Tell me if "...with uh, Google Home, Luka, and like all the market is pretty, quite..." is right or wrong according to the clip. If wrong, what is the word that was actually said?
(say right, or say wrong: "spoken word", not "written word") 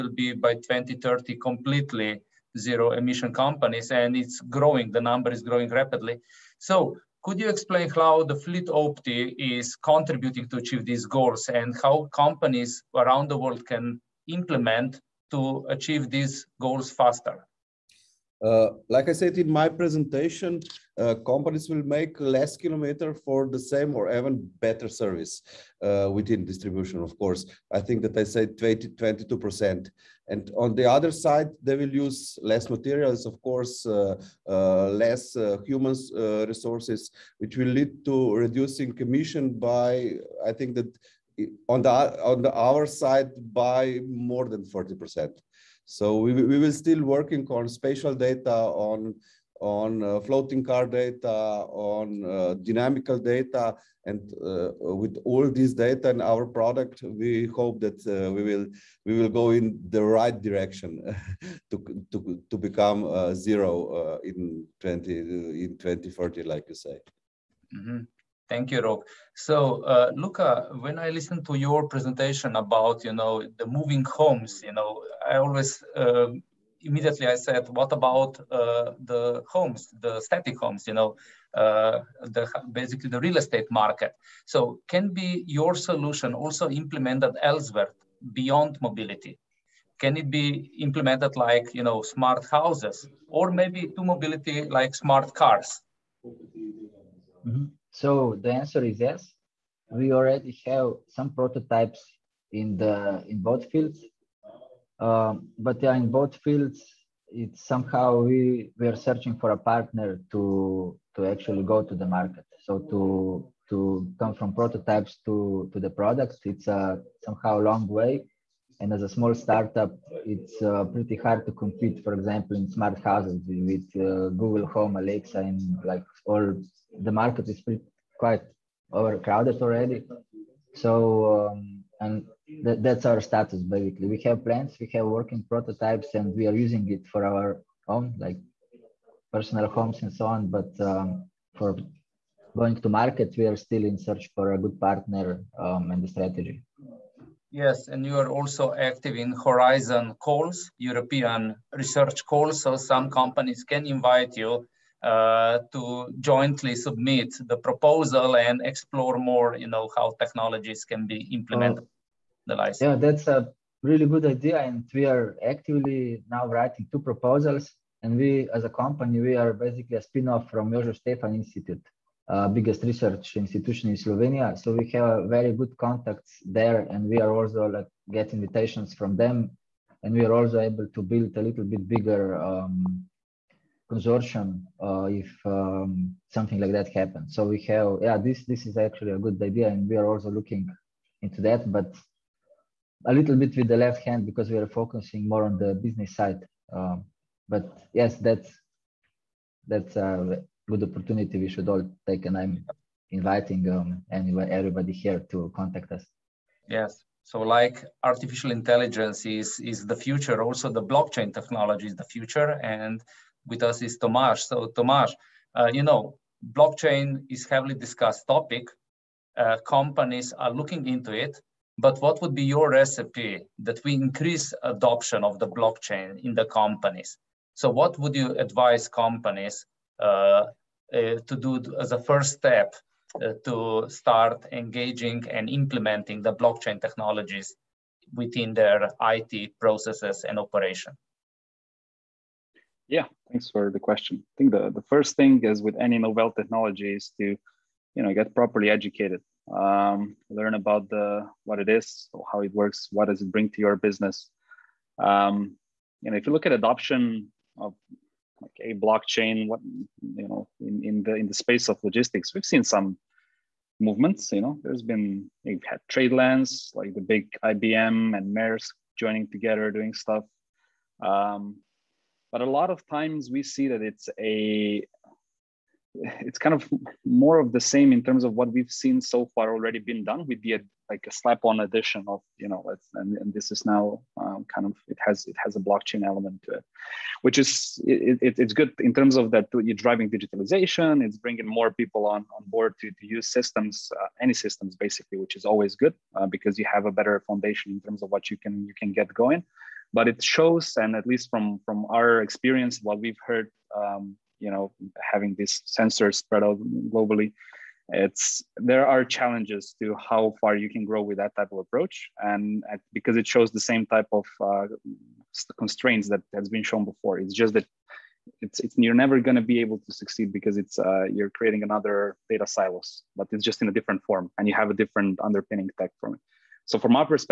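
wrong: "Alexa", not "Luka".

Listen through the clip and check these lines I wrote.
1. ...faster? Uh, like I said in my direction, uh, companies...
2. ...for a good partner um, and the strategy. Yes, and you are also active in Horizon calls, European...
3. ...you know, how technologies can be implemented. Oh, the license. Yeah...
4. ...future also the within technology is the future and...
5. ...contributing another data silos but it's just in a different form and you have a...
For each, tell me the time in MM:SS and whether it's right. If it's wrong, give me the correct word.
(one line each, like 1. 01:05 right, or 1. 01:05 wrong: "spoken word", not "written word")
1. 00:16 wrong: "presentation", not "direction"
2. 02:24 right
3. 02:39 right
4. 03:29 wrong: "blockchain", not "within"
5. 05:21 wrong: "creating", not "contributing".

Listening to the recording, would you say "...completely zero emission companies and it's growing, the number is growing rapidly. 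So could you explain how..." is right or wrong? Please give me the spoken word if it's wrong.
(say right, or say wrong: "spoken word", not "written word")
right.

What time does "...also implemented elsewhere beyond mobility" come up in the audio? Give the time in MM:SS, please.
01:26.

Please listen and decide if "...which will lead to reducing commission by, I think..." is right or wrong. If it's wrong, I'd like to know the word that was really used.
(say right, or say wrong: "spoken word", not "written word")
right.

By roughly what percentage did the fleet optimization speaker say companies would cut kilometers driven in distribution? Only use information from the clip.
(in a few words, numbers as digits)
22%.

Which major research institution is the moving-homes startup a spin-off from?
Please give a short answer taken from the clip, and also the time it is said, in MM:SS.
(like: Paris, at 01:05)
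Jožef Stefan Institute, at 02:50.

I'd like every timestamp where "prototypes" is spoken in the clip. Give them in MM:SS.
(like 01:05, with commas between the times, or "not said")
01:41, 01:54, 02:15.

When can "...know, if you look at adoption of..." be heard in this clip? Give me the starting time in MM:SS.
04:16.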